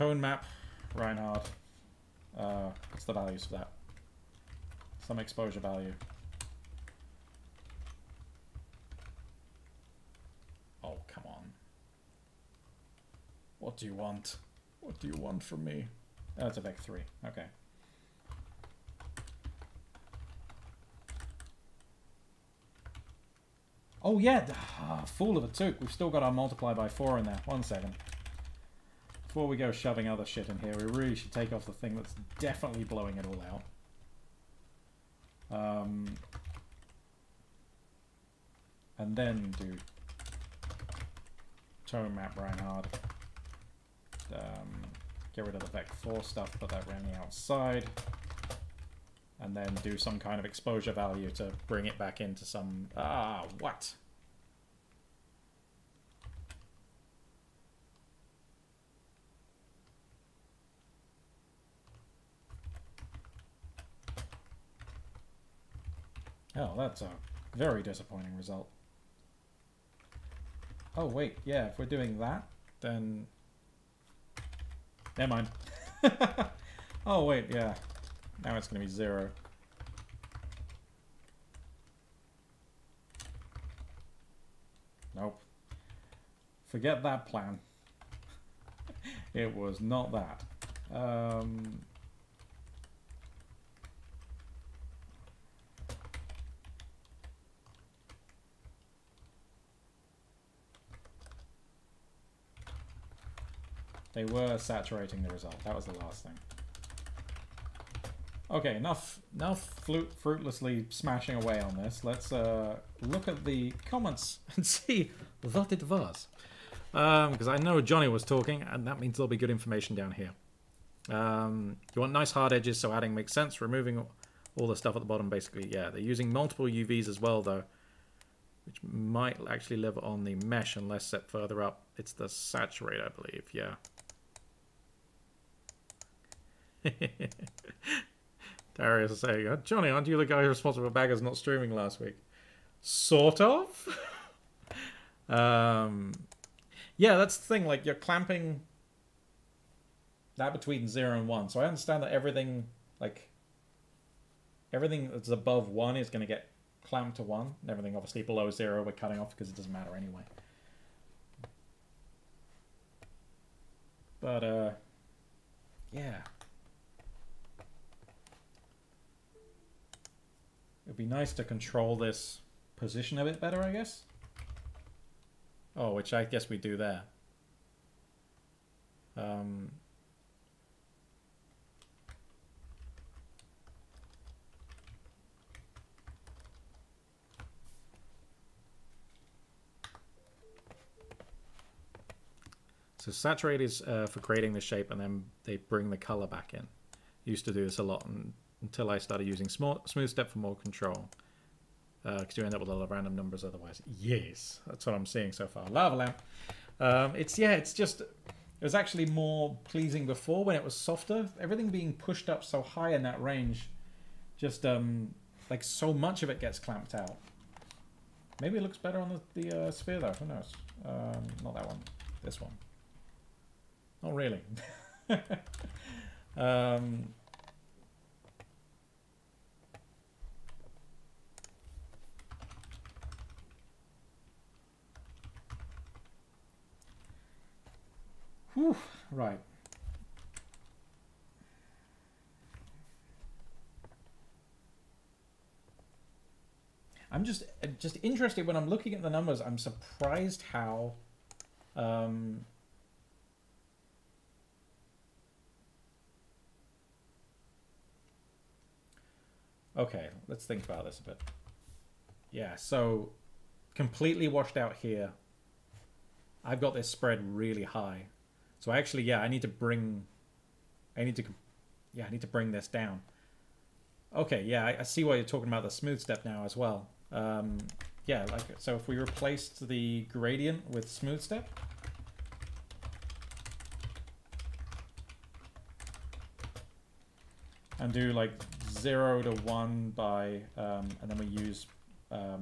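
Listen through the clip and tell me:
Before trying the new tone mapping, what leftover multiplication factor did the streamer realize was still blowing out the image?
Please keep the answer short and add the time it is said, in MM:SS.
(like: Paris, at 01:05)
4, at 00:26.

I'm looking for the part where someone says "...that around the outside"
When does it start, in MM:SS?
00:46.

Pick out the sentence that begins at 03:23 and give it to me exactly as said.
Yes, that's what I'm seeing so far.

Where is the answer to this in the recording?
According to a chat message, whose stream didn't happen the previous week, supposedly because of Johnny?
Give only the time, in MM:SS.
02:20.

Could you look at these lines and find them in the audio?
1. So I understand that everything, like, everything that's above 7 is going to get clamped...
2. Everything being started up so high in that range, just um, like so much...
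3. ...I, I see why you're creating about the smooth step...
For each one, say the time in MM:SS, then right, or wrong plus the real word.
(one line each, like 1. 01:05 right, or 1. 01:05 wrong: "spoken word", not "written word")
1. 02:31 wrong: "1", not "7"
2. 03:31 wrong: "pushed", not "started"
3. 04:34 wrong: "talking", not "creating".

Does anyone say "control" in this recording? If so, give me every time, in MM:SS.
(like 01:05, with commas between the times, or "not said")
02:51, 03:20.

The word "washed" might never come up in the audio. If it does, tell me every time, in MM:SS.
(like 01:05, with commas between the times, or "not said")
04:24.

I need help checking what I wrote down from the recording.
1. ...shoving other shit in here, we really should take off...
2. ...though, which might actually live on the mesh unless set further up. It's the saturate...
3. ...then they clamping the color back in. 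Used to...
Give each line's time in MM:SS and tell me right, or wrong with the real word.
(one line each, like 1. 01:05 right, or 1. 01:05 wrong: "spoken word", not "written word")
1. 00:29 right
2. 02:07 right
3. 03:14 wrong: "bring", not "clamping".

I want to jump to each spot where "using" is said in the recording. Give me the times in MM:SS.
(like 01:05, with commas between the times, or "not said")
02:06, 03:19.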